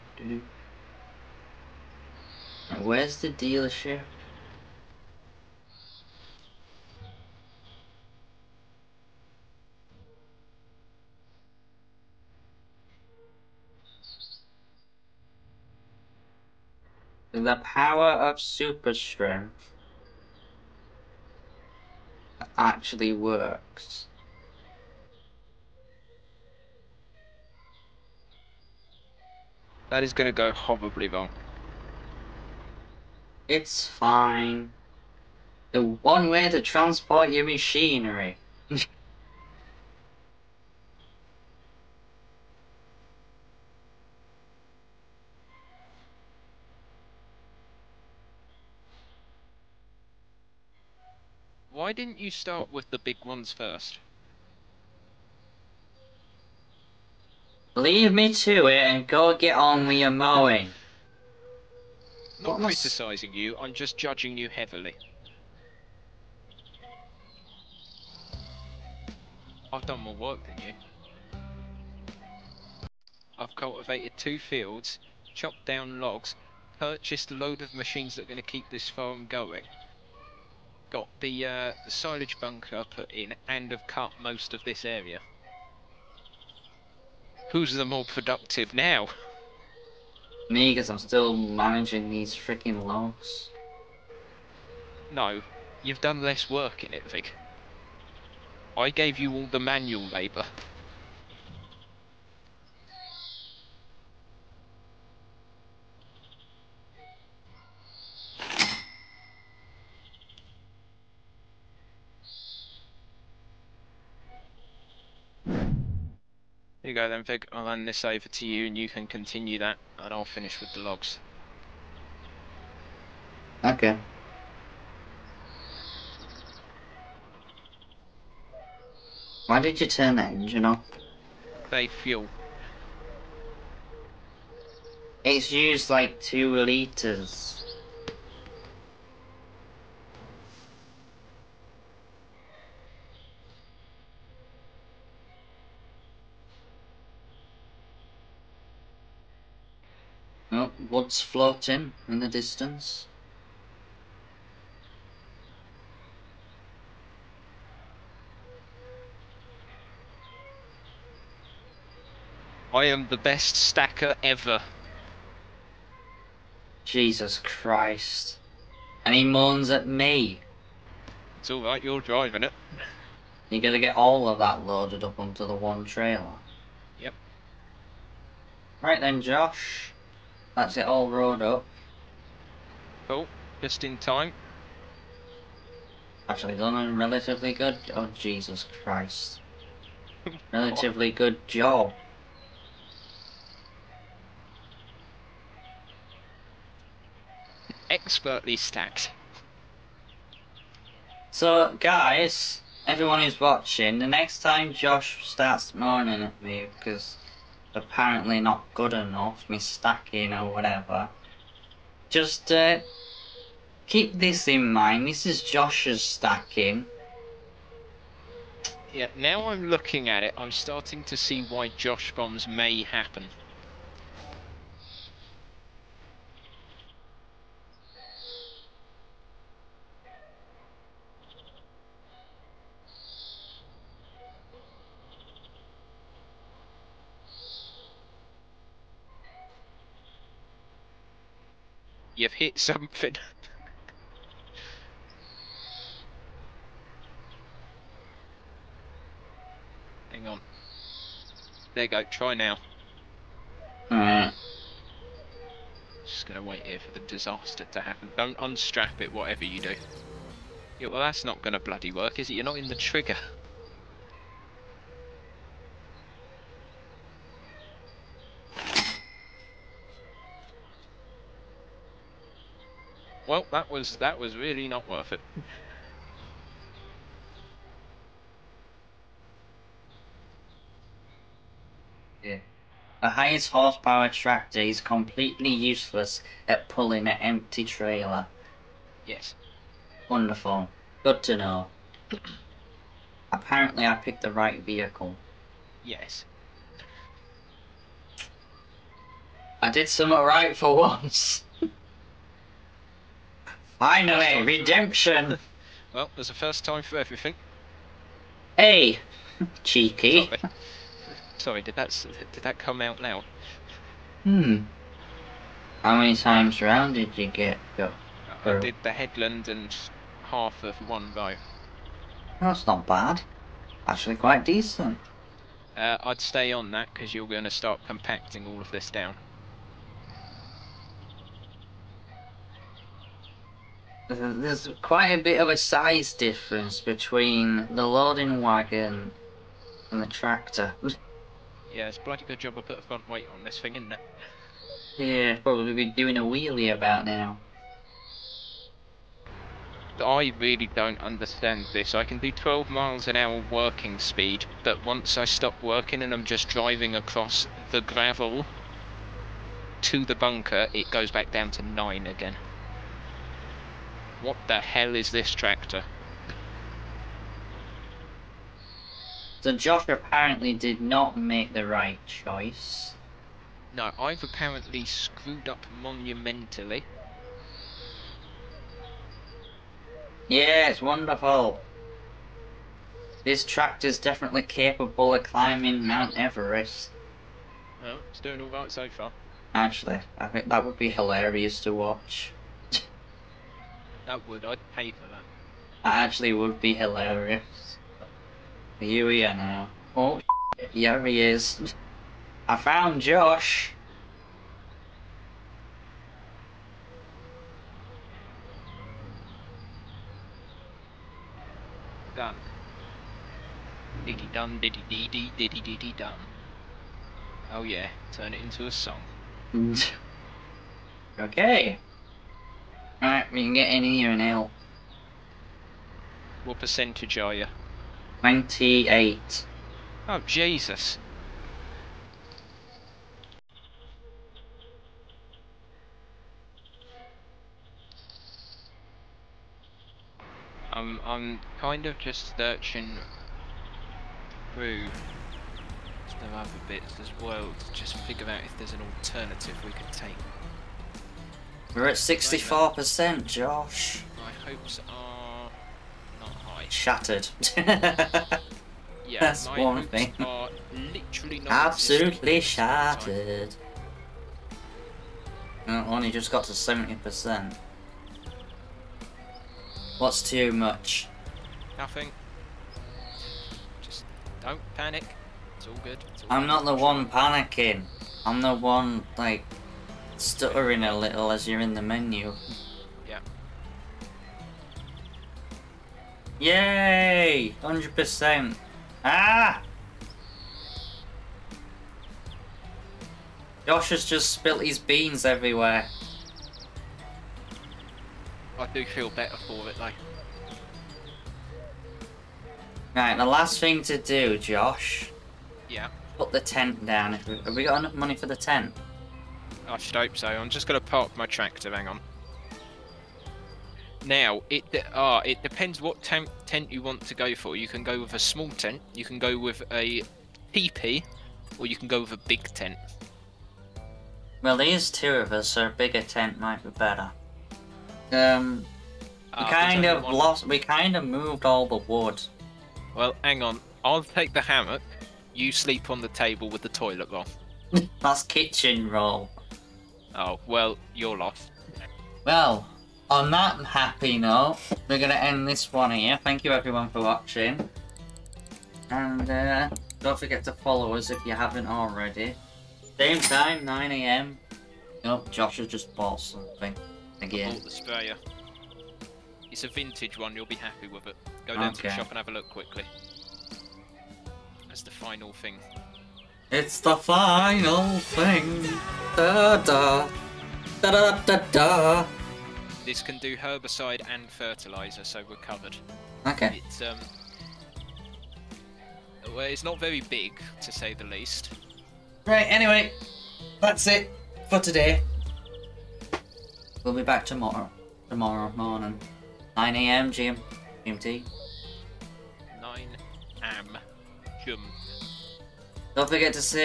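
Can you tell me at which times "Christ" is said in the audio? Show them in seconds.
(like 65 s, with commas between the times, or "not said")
167 s, 188 s.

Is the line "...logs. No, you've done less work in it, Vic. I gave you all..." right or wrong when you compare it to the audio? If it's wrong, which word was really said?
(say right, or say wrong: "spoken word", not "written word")
right.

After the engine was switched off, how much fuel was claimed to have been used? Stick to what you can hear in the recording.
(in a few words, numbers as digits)
2 litres.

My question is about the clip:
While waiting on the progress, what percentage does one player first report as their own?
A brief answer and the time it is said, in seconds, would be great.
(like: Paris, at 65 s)
28, at 428 s.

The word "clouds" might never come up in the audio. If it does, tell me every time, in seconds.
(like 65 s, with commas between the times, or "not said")
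151 s.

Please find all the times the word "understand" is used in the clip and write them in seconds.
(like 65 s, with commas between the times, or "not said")
351 s.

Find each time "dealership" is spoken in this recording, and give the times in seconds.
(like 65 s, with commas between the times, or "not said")
3 s.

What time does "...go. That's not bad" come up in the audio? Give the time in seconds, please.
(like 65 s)
321 s.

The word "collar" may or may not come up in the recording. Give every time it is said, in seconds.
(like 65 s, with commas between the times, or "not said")
not said.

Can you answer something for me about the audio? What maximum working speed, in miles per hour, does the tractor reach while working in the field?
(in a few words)
12.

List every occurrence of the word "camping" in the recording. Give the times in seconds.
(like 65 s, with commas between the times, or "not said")
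not said.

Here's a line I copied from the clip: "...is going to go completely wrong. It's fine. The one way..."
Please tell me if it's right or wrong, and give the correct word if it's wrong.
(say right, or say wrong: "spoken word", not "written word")
wrong: "horribly", not "completely".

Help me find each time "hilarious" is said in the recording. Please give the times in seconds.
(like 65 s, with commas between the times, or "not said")
390 s, 396 s.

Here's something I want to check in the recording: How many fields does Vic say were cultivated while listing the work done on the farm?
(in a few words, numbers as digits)
2.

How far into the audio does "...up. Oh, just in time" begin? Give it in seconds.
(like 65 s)
181 s.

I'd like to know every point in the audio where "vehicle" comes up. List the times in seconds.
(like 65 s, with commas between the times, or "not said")
294 s.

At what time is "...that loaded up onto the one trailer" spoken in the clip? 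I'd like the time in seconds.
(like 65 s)
174 s.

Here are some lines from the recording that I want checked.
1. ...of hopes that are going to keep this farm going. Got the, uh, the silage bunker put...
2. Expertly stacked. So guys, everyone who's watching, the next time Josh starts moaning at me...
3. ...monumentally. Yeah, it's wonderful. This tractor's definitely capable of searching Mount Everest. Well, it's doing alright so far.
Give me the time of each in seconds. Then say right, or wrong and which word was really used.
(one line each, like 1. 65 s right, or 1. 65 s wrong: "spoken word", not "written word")
1. 77 s wrong: "machines", not "hopes"
2. 197 s right
3. 375 s wrong: "climbing", not "searching".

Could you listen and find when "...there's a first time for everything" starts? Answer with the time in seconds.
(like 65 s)
306 s.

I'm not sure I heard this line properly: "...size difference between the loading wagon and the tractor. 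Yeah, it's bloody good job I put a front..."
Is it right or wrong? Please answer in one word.
right.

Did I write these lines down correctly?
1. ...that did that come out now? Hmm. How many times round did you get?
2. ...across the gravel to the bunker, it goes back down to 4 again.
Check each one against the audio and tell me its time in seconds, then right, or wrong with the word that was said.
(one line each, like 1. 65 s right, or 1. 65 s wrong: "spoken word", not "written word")
1. 311 s right
2. 356 s wrong: "9", not "4".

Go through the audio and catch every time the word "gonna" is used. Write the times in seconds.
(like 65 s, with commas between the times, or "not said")
173 s, 256 s, 261 s.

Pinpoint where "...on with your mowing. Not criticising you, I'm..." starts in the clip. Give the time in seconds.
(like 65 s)
59 s.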